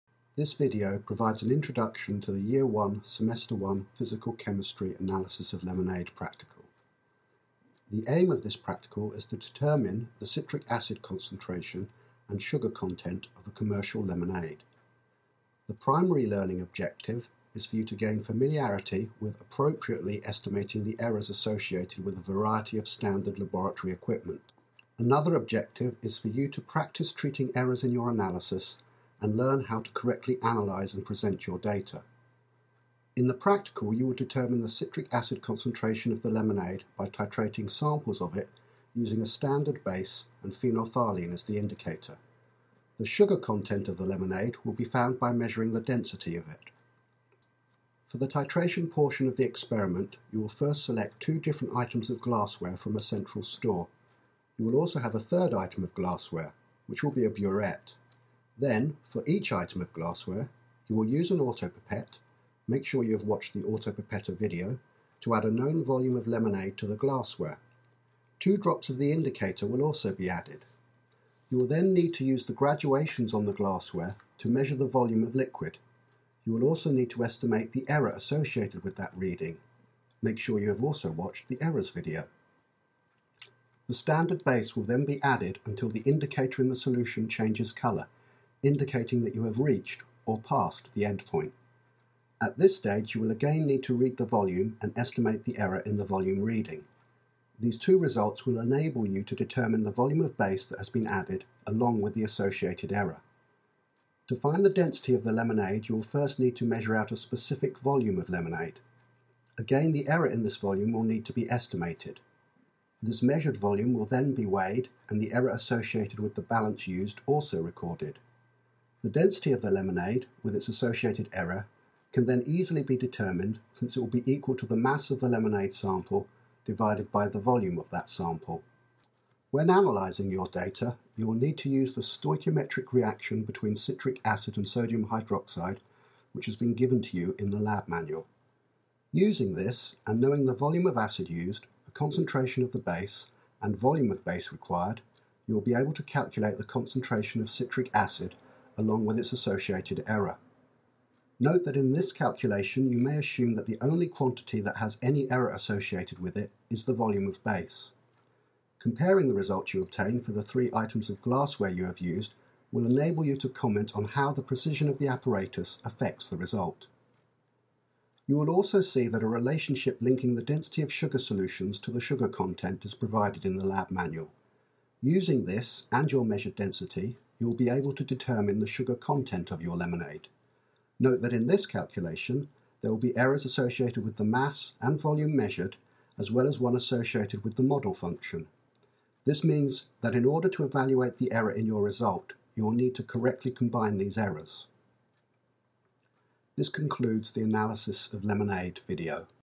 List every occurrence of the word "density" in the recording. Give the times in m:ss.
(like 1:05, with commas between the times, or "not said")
0:45, 1:44, 1:59, 2:50, 2:56.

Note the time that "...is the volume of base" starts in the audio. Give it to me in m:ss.
2:36.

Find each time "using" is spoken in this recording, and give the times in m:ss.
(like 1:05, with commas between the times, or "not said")
0:38, 2:19, 2:55.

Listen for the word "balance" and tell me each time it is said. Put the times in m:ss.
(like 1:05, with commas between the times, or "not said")
1:56.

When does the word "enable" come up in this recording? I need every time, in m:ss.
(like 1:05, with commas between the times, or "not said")
1:38, 2:42.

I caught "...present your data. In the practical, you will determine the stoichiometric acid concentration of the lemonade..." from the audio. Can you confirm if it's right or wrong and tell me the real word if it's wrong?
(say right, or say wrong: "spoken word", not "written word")
wrong: "citric", not "stoichiometric".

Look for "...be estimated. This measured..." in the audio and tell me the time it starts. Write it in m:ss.
1:51.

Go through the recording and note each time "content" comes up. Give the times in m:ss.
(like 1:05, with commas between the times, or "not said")
0:12, 0:43, 2:52, 2:58.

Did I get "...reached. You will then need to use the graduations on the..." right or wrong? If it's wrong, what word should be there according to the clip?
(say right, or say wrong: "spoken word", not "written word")
wrong: "added", not "reached".